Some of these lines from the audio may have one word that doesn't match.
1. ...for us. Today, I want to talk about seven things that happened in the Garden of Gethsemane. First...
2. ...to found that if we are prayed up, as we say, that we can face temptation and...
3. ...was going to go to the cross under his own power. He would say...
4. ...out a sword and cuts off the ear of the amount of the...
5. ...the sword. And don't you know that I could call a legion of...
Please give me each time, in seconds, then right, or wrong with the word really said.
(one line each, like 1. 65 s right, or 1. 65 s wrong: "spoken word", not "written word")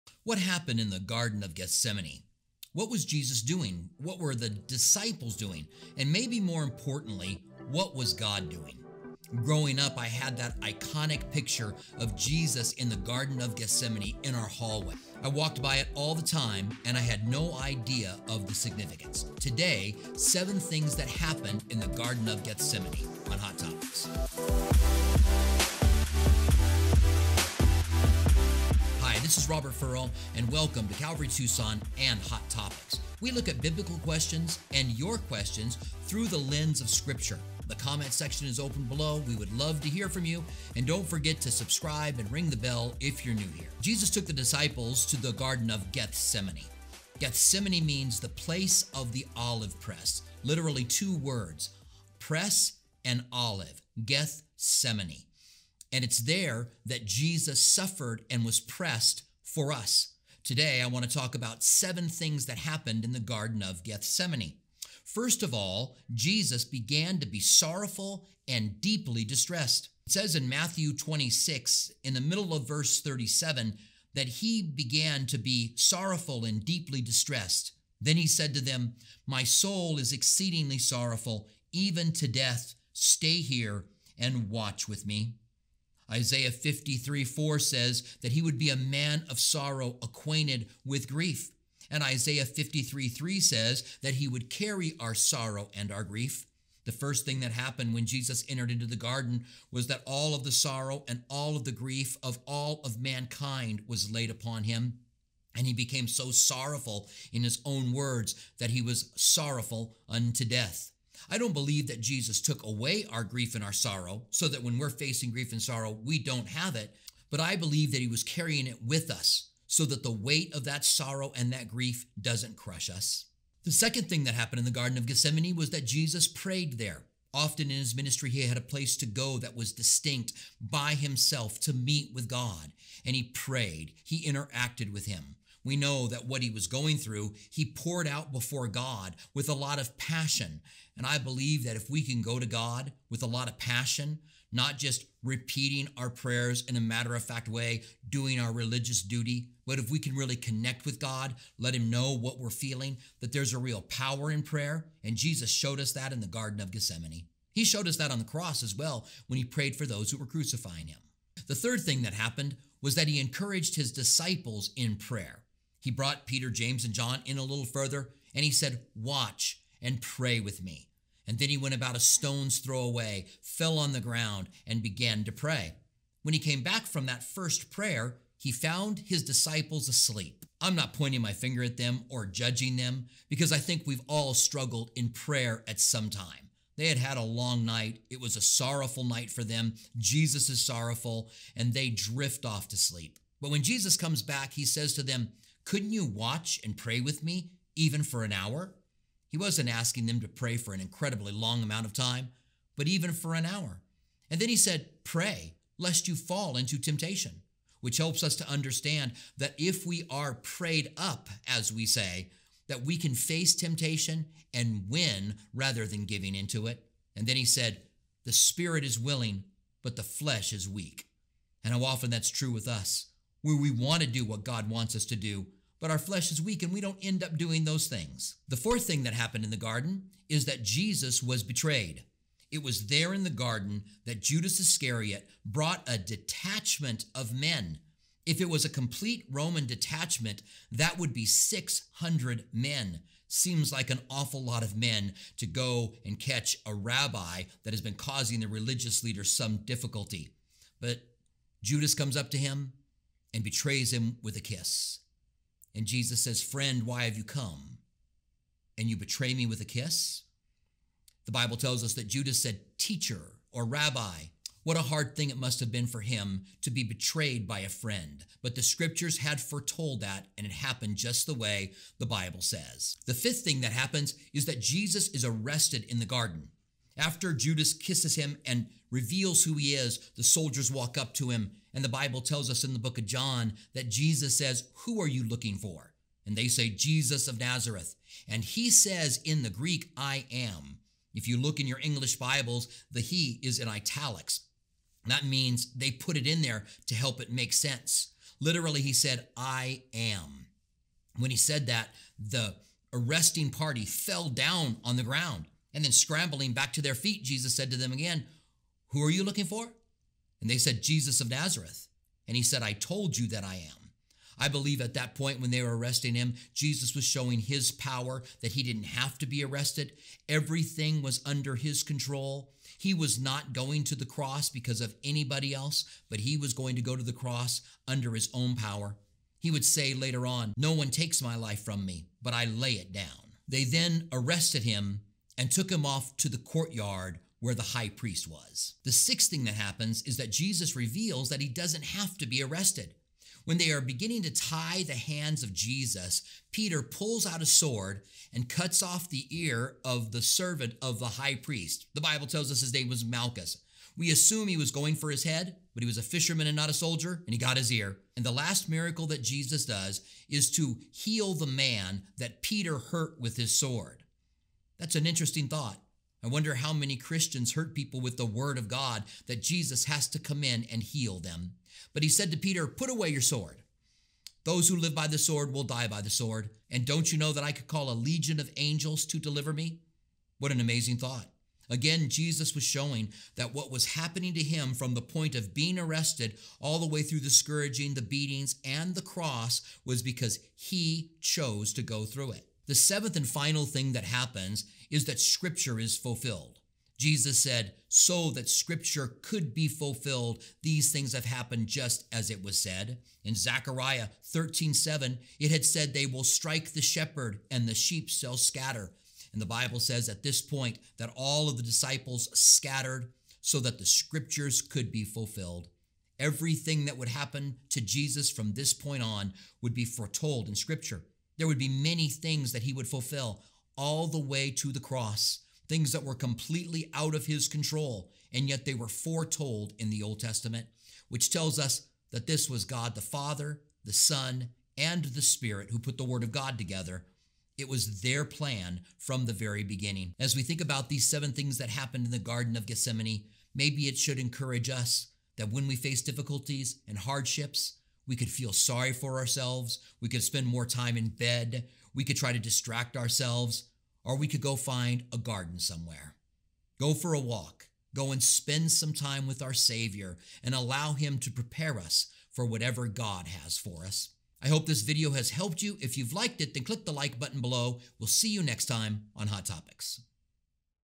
1. 59 s right
2. 208 s wrong: "understand", not "found"
3. 326 s right
4. 347 s wrong: "servant", not "amount"
5. 376 s right.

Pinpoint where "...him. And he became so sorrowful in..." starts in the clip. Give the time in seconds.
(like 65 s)
104 s.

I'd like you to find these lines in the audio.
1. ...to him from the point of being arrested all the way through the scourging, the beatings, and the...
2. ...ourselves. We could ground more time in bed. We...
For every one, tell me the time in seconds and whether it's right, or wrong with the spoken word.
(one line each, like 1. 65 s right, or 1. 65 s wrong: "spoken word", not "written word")
1. 384 s right
2. 449 s wrong: "spend", not "ground".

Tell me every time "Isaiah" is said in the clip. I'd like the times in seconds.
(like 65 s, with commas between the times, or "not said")
86 s, 92 s.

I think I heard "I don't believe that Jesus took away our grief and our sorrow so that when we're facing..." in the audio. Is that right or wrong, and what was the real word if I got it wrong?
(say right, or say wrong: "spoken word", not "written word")
right.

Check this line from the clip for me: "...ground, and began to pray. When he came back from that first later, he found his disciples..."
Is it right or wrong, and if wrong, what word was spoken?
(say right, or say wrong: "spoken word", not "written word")
wrong: "prayer", not "later".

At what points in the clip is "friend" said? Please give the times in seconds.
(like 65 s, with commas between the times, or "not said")
256 s, 267 s.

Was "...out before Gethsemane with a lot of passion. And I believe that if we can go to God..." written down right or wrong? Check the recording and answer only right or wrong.
wrong.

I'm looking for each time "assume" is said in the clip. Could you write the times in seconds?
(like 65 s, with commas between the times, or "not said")
354 s.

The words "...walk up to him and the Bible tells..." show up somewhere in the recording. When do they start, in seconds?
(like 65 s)
280 s.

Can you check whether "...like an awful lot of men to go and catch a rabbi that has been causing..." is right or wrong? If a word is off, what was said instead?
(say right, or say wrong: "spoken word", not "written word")
right.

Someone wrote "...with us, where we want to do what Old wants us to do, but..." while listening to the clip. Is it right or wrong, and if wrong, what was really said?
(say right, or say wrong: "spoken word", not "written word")
wrong: "God", not "Old".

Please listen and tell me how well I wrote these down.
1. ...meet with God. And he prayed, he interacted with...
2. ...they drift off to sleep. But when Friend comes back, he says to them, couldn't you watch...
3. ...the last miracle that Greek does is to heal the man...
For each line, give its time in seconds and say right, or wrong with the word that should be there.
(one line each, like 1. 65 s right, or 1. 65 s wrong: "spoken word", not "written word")
1. 131 s right
2. 191 s wrong: "Jesus", not "Friend"
3. 358 s wrong: "Jesus", not "Greek".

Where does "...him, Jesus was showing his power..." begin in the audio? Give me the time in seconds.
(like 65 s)
316 s.